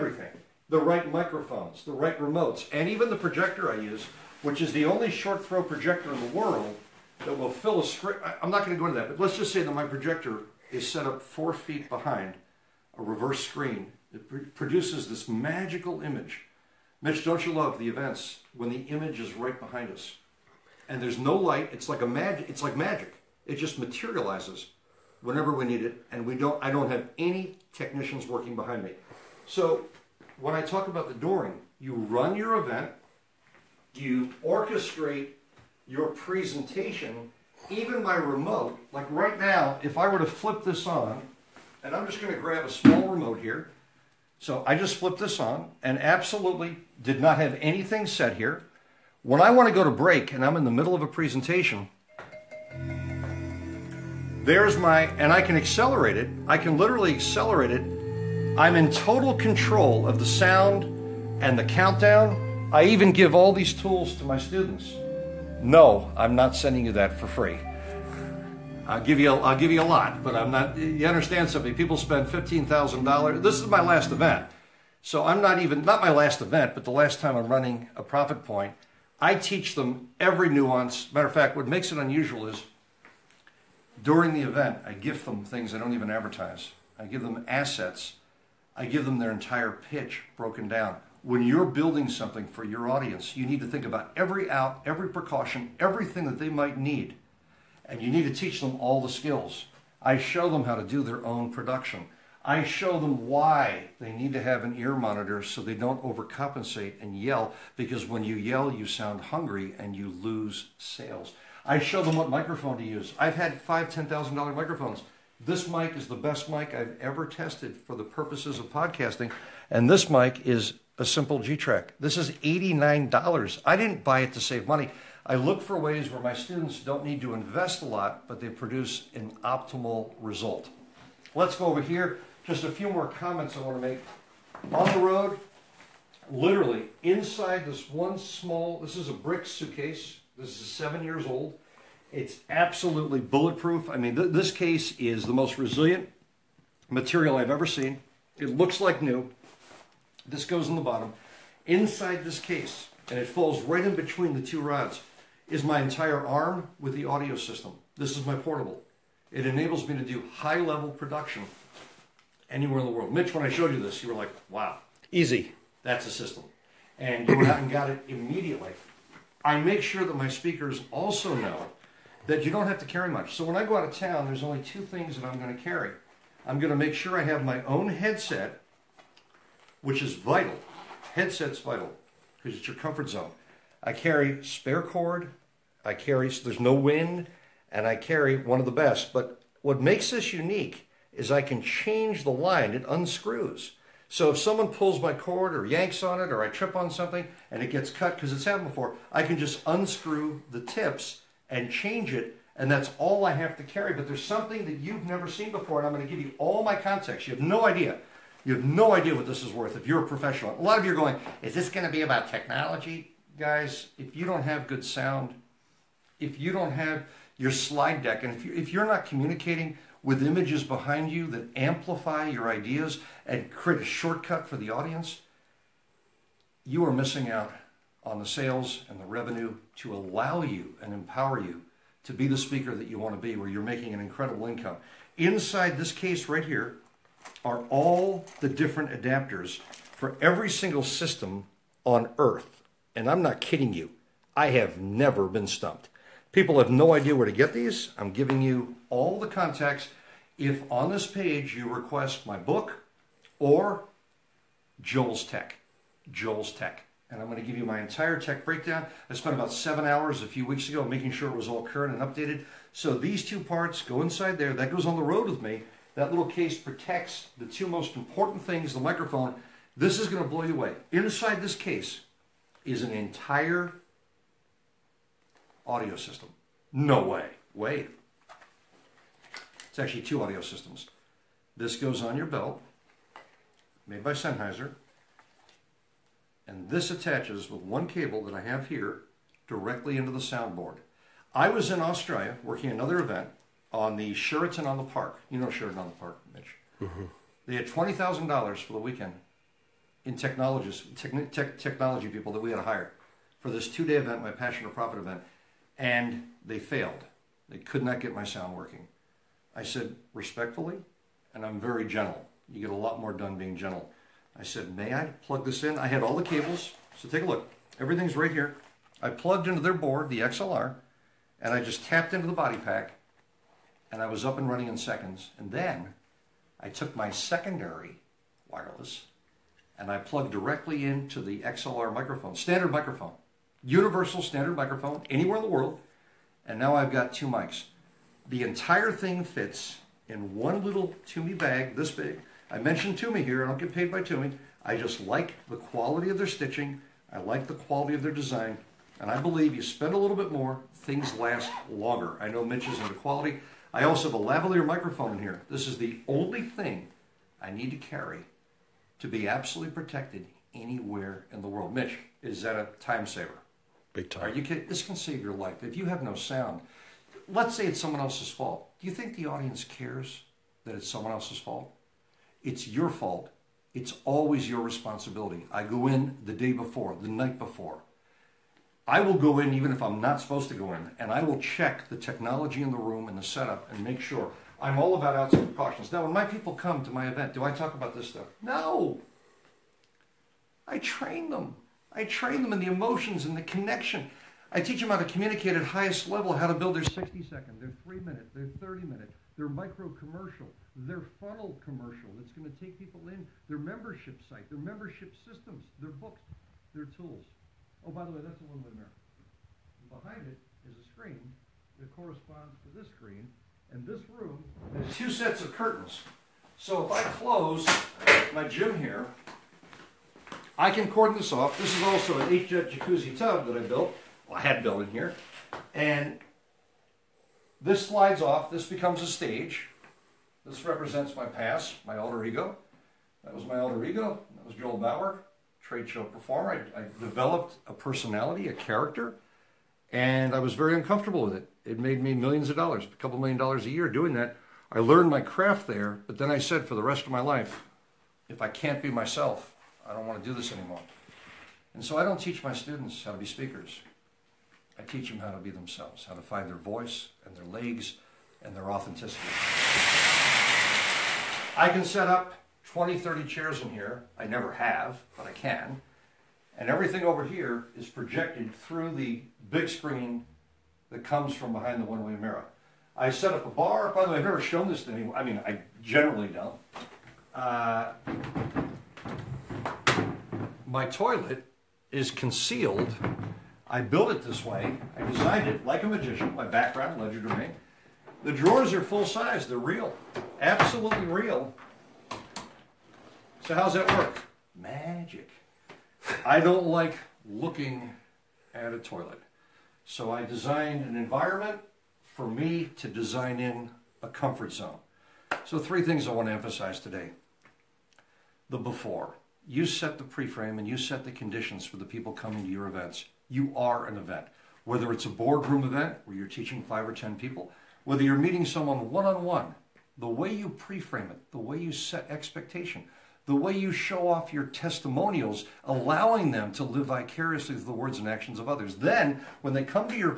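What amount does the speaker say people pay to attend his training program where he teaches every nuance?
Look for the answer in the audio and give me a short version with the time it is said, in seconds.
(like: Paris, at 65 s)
$15,000, at 72 s.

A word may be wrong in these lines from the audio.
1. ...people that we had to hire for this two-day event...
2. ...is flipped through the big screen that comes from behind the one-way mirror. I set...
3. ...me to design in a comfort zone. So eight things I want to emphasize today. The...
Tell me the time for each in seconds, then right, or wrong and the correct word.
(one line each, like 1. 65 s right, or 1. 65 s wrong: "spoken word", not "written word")
1. 302 s right
2. 467 s wrong: "projected", not "flipped"
3. 502 s wrong: "three", not "eight".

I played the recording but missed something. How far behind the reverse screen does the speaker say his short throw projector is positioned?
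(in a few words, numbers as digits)
4 feet.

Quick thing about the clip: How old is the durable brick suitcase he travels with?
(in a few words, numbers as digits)
7 years.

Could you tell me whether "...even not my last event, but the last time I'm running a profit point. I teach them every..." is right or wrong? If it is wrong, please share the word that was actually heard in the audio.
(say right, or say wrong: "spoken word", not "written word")
right.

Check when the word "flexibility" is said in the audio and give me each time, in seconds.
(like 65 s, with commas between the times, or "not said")
not said.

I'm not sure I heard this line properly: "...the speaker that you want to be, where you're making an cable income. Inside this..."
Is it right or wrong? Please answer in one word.
wrong.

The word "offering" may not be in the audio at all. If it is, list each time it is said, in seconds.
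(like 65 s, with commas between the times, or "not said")
not said.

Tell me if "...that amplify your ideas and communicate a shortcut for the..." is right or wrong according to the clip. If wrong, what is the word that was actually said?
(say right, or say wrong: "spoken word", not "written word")
wrong: "create", not "communicate".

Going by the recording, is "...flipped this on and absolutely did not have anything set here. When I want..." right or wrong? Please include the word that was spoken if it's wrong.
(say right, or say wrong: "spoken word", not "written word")
right.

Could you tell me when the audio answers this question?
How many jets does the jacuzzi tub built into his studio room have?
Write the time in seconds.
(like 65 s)
422 s.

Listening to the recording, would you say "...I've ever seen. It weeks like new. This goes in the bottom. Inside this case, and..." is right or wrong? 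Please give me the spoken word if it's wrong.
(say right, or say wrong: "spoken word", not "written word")
wrong: "looks", not "weeks".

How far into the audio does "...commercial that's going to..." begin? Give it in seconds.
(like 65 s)
401 s.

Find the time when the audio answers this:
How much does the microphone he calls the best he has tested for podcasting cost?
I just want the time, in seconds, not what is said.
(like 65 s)
122 s.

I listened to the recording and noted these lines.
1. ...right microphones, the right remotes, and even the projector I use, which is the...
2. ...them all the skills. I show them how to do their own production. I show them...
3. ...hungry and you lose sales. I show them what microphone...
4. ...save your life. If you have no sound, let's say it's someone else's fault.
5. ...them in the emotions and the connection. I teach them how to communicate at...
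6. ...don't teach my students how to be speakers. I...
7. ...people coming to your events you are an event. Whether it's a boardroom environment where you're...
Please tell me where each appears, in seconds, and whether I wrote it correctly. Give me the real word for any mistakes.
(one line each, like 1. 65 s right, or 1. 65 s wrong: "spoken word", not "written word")
1. 0 s right
2. 98 s right
3. 109 s right
4. 364 s right
5. 392 s right
6. 452 s right
7. 511 s wrong: "event", not "environment".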